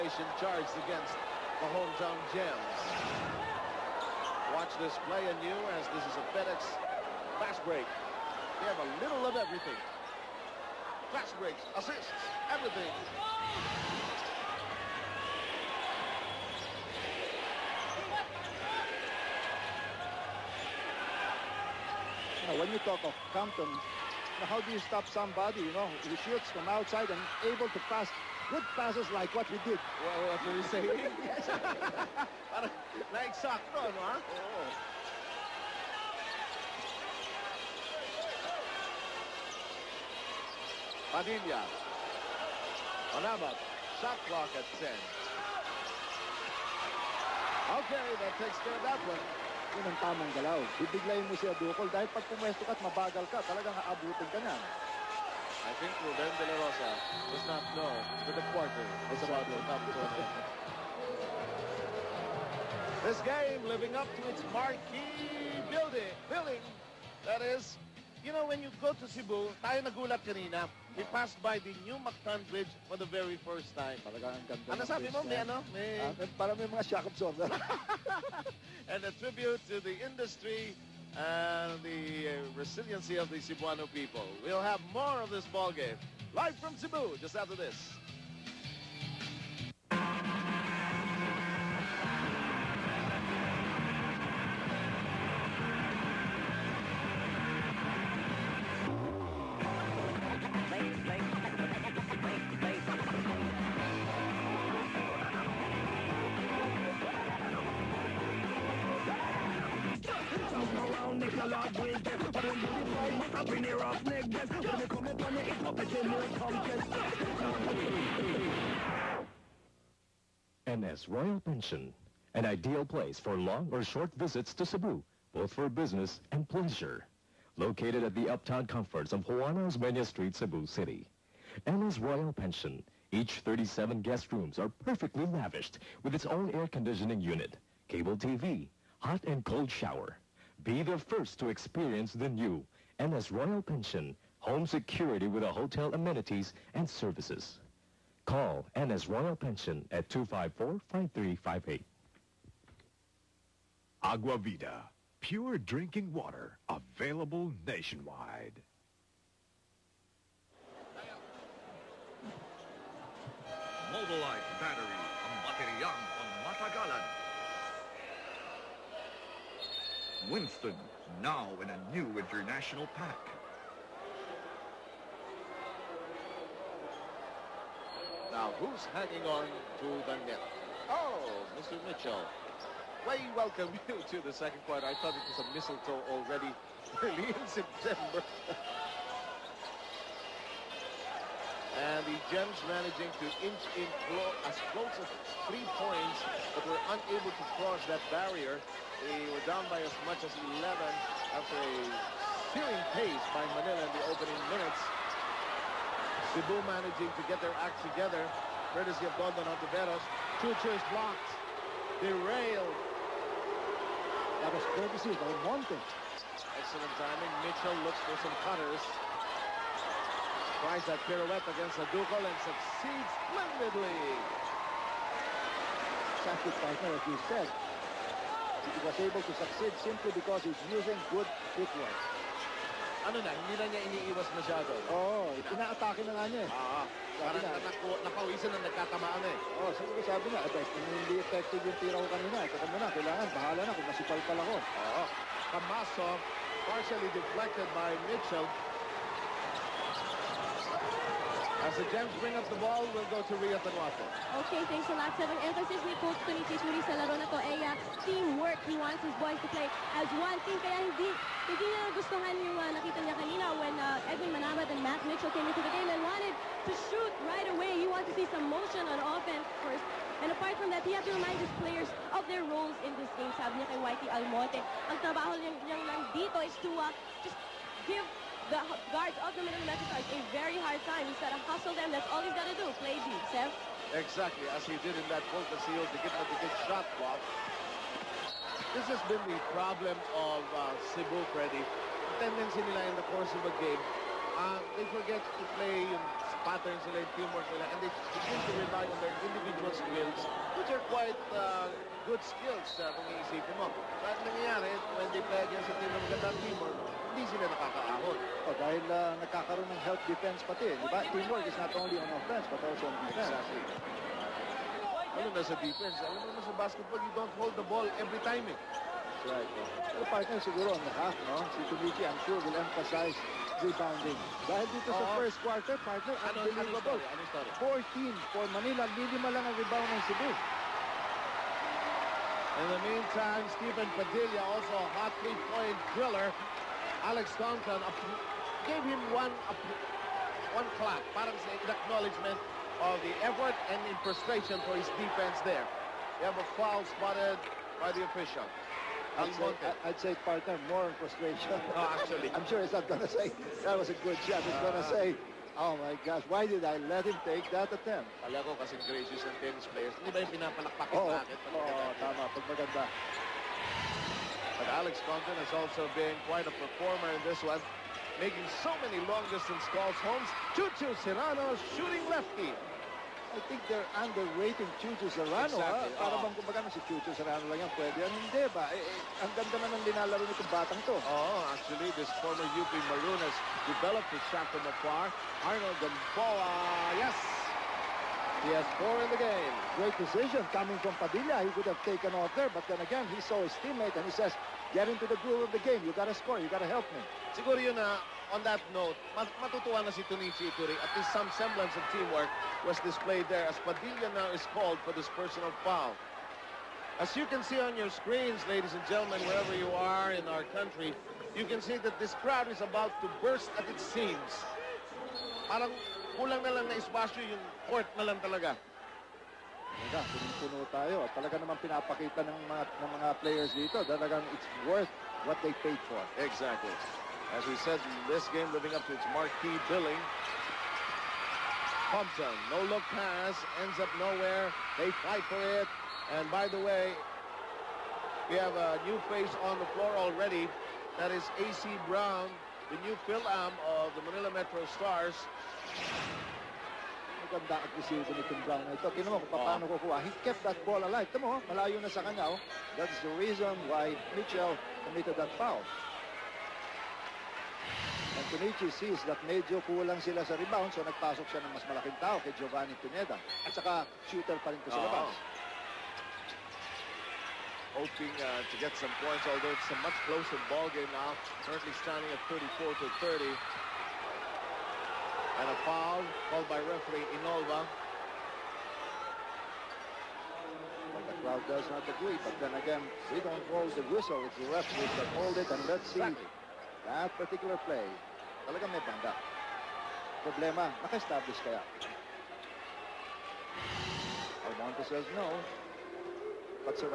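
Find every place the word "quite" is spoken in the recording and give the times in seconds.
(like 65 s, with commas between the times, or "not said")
300 s, 366 s.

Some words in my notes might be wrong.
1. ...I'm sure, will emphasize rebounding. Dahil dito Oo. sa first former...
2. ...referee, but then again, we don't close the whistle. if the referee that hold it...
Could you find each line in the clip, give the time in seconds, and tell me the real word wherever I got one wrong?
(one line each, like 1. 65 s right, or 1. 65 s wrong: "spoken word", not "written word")
1. 322 s wrong: "quarter", not "former"
2. 481 s wrong: "agree", not "referee".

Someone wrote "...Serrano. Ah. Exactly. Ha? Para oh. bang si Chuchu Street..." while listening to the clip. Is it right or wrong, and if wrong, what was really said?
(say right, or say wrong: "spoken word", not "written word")
wrong: "Serrano", not "Street".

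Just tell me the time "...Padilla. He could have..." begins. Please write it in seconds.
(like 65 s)
391 s.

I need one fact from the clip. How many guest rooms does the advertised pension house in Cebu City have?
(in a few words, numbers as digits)
37.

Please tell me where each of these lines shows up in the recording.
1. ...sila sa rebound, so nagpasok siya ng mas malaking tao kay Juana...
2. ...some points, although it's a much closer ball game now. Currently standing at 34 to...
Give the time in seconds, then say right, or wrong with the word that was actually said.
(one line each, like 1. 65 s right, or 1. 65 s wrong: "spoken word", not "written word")
1. 459 s wrong: "Giovanni", not "Juana"
2. 468 s right.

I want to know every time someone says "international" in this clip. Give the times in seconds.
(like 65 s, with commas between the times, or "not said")
172 s.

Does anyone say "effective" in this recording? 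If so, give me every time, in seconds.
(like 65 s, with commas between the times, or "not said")
241 s.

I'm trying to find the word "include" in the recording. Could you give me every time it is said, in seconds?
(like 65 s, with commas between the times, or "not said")
not said.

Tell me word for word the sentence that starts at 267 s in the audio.
He wants to see some motion on offense first.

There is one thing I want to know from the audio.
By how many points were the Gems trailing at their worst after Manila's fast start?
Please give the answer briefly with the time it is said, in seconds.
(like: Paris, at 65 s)
11, at 200 s.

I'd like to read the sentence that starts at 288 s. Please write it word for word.
This has been the problem of uh, Cebu, Freddy.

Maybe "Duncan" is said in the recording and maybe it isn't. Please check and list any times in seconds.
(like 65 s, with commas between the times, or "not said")
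337 s, 365 s.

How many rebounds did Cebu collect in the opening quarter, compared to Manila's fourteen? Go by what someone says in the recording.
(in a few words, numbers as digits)
5.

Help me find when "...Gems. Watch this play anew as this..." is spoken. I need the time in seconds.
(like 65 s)
2 s.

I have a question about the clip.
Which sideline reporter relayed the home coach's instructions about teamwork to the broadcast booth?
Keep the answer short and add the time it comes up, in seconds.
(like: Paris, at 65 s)
Ria Tanjuatco, at 253 s.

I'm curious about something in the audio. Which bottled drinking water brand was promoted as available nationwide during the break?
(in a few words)
Agua Vida.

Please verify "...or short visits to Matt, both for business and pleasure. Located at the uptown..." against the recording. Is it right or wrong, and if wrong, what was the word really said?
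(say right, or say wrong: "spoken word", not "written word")
wrong: "Cebu", not "Matt".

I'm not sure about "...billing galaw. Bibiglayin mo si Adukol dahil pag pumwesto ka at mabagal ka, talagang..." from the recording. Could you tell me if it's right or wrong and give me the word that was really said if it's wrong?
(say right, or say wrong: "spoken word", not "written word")
wrong: "tamang", not "billing".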